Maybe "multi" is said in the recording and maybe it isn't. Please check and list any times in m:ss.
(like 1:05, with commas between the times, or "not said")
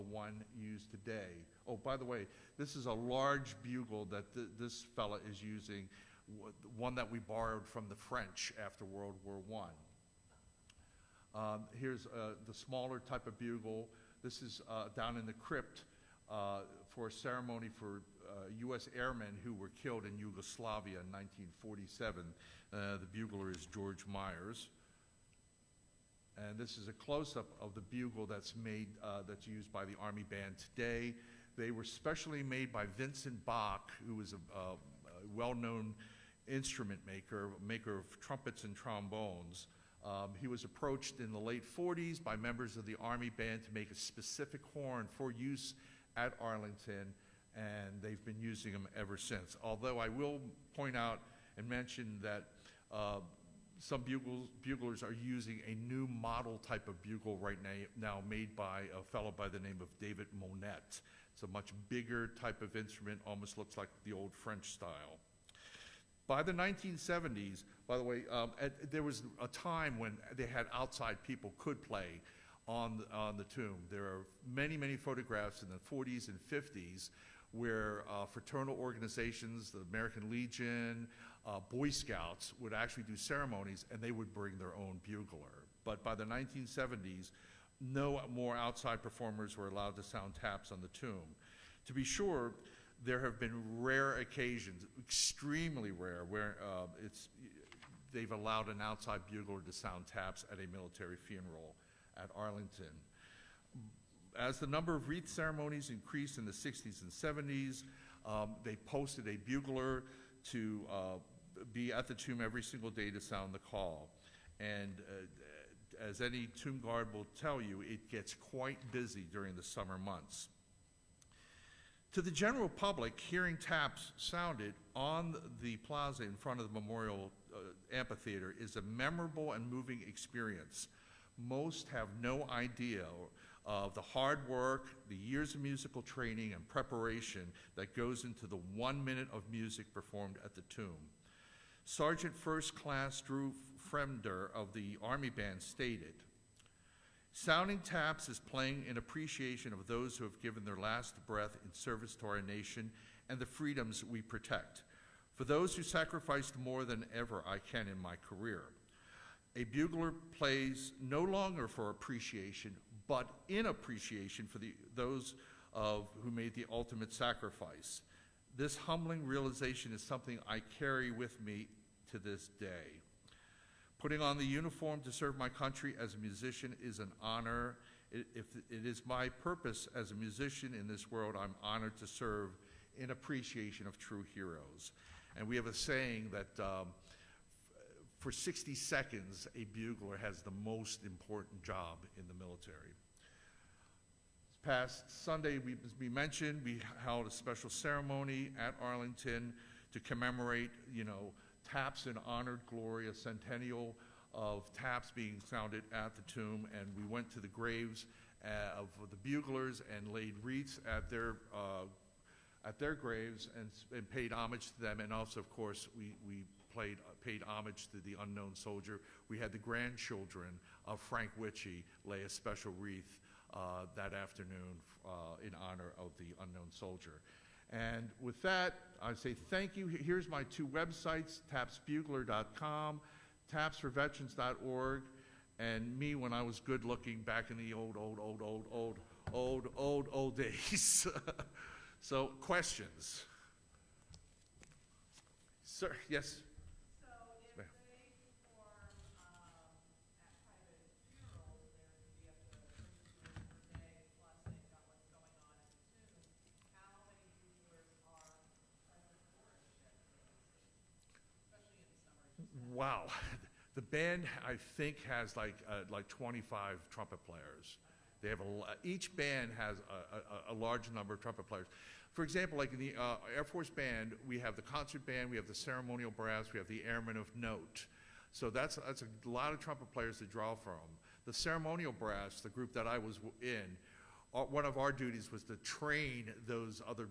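not said.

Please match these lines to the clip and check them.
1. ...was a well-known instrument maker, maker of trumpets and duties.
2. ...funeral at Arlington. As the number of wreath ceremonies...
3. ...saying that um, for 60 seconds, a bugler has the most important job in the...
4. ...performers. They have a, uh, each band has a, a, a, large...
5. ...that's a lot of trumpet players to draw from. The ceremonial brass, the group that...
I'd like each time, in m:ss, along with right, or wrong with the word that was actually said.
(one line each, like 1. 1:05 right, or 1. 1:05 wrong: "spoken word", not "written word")
1. 0:34 wrong: "trombones", not "duties"
2. 1:41 right
3. 3:05 right
4. 4:27 wrong: "players", not "performers"
5. 4:38 right.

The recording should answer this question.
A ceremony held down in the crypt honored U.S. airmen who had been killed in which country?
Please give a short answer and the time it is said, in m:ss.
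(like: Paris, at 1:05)
Yugoslavia, at 0:20.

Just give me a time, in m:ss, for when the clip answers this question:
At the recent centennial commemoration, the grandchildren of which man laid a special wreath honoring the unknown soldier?
3:40.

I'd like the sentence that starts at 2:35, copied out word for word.
For those who sacrificed more than ever I can in my career.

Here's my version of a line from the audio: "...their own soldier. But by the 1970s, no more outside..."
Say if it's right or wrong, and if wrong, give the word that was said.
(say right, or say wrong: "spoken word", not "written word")
wrong: "bugler", not "soldier".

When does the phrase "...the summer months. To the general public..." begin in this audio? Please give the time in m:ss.
1:59.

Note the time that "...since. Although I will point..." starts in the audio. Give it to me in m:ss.
0:49.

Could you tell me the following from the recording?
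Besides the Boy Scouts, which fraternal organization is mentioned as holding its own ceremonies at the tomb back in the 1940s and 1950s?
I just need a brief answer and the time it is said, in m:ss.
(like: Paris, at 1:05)
American Legion, at 1:19.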